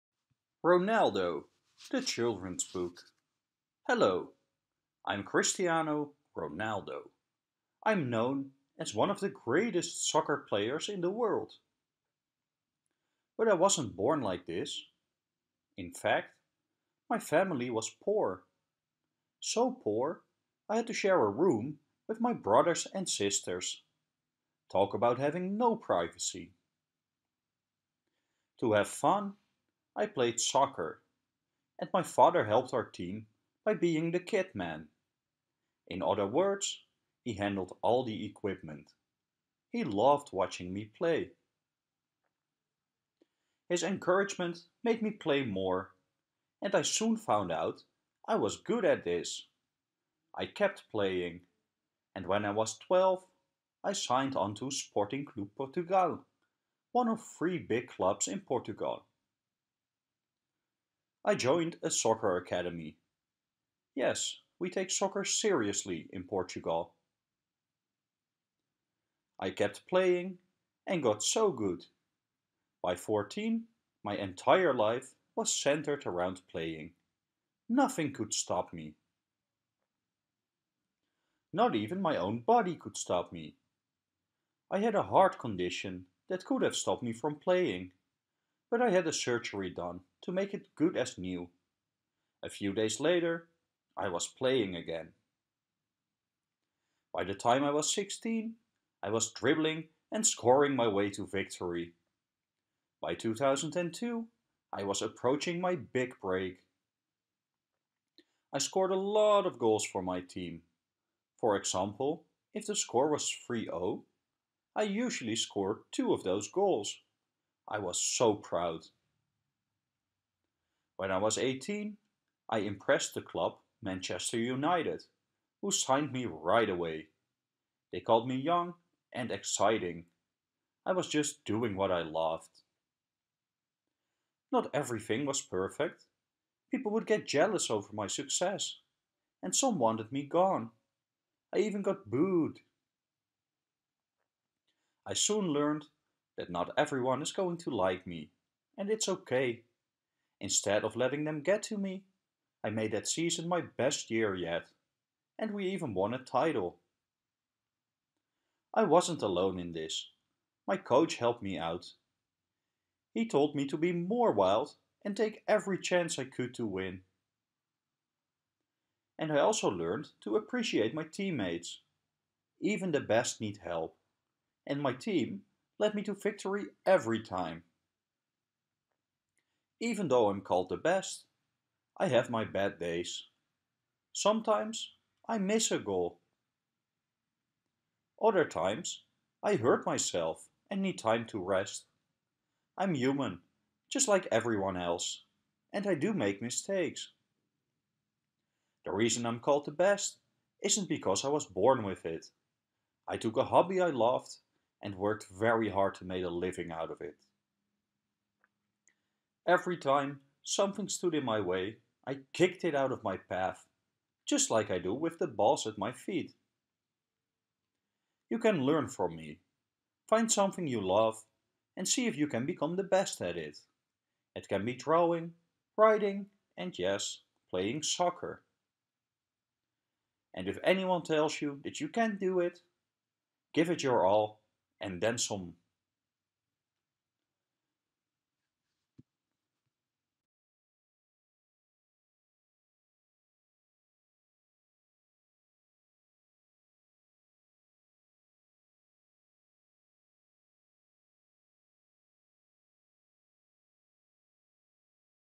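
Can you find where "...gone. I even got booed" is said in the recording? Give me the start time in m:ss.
2:20.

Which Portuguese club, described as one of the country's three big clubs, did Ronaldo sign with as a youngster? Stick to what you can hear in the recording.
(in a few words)
Sporting Clube Portugal.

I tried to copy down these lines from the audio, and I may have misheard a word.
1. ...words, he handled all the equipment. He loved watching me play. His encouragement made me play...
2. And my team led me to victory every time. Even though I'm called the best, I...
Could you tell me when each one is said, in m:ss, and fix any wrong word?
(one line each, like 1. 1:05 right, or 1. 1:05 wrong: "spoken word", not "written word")
1. 0:36 right
2. 2:54 right.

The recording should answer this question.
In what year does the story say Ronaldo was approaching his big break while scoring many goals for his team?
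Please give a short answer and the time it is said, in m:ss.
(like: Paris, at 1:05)
2002, at 1:43.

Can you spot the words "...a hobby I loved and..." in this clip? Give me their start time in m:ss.
3:23.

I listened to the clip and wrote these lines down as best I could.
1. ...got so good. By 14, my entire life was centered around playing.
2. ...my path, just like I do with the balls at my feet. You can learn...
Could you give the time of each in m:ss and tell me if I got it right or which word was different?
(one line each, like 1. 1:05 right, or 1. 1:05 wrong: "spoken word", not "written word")
1. 1:11 right
2. 3:33 right.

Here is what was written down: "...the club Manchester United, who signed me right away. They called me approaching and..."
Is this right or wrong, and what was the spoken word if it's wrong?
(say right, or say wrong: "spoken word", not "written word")
wrong: "young", not "approaching".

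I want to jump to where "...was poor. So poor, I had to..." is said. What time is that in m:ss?
0:17.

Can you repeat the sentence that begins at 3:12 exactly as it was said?
I'm human, just like everyone else, and I do make mistakes.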